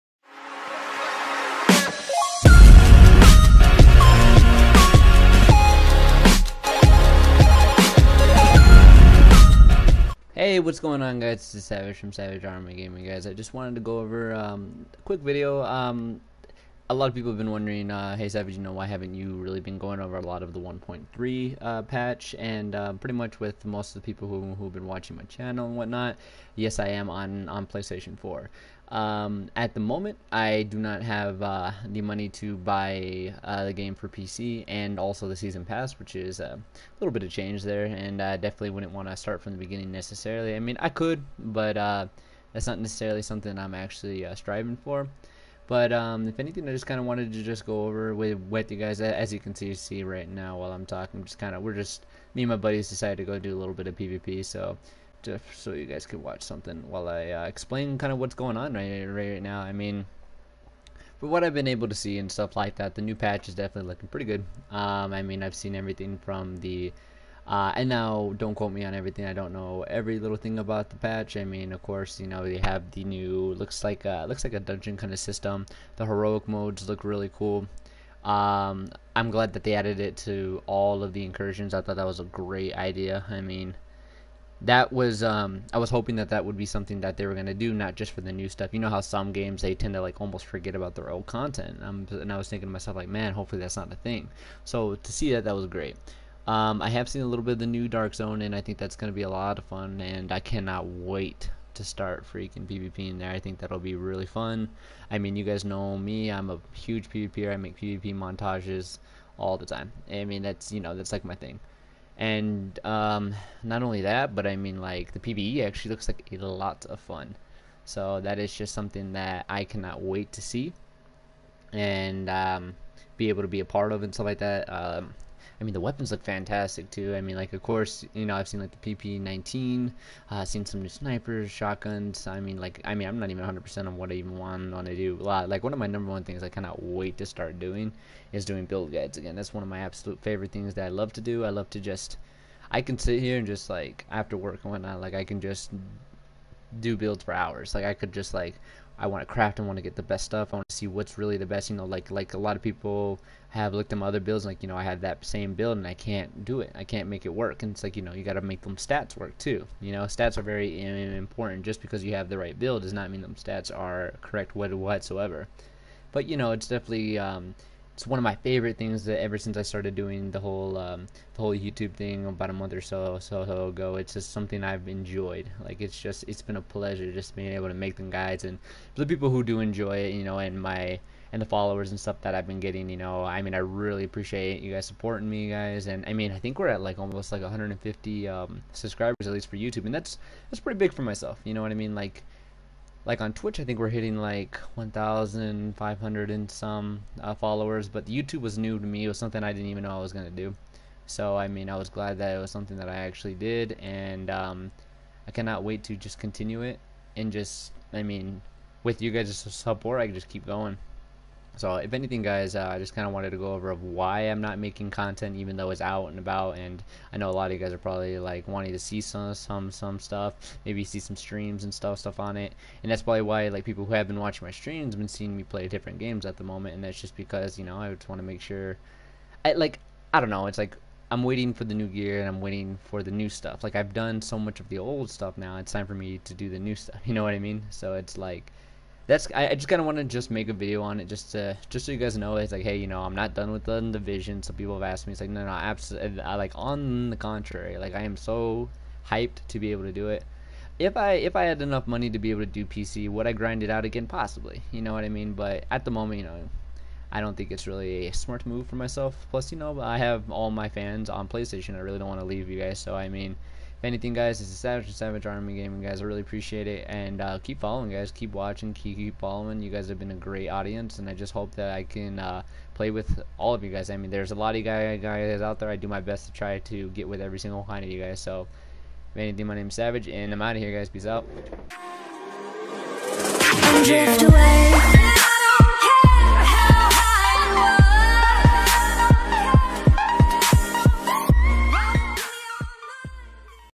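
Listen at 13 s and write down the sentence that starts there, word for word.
I just wanted to go over um, a quick video.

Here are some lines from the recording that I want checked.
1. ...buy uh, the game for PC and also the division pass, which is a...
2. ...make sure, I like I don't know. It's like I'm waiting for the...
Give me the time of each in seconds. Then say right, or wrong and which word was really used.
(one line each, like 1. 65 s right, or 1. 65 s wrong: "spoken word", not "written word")
1. 32 s wrong: "season", not "division"
2. 228 s right.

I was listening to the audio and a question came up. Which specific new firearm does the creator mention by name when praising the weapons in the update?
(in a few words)
PP19.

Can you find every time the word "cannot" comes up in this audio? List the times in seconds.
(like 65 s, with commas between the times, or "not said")
100 s, 119 s, 136 s, 205 s.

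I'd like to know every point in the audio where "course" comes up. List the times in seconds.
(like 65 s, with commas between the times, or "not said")
71 s, 127 s.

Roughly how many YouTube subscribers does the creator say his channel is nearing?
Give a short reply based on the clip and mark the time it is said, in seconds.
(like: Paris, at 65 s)
150, at 187 s.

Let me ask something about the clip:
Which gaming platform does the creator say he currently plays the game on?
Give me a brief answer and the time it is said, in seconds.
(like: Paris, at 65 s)
PlayStation 4, at 27 s.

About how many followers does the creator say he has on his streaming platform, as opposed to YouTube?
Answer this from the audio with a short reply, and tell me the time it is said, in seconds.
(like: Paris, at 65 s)
1,500, at 194 s.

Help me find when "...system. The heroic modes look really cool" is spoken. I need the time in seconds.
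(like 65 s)
75 s.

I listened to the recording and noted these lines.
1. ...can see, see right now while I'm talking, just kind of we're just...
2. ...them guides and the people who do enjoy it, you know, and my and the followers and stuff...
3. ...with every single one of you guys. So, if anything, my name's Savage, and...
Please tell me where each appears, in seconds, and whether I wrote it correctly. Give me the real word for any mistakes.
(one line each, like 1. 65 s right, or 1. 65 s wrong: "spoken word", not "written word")
1. 49 s right
2. 177 s right
3. 277 s right.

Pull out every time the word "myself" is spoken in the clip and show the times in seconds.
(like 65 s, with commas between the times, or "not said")
92 s, 191 s, 258 s.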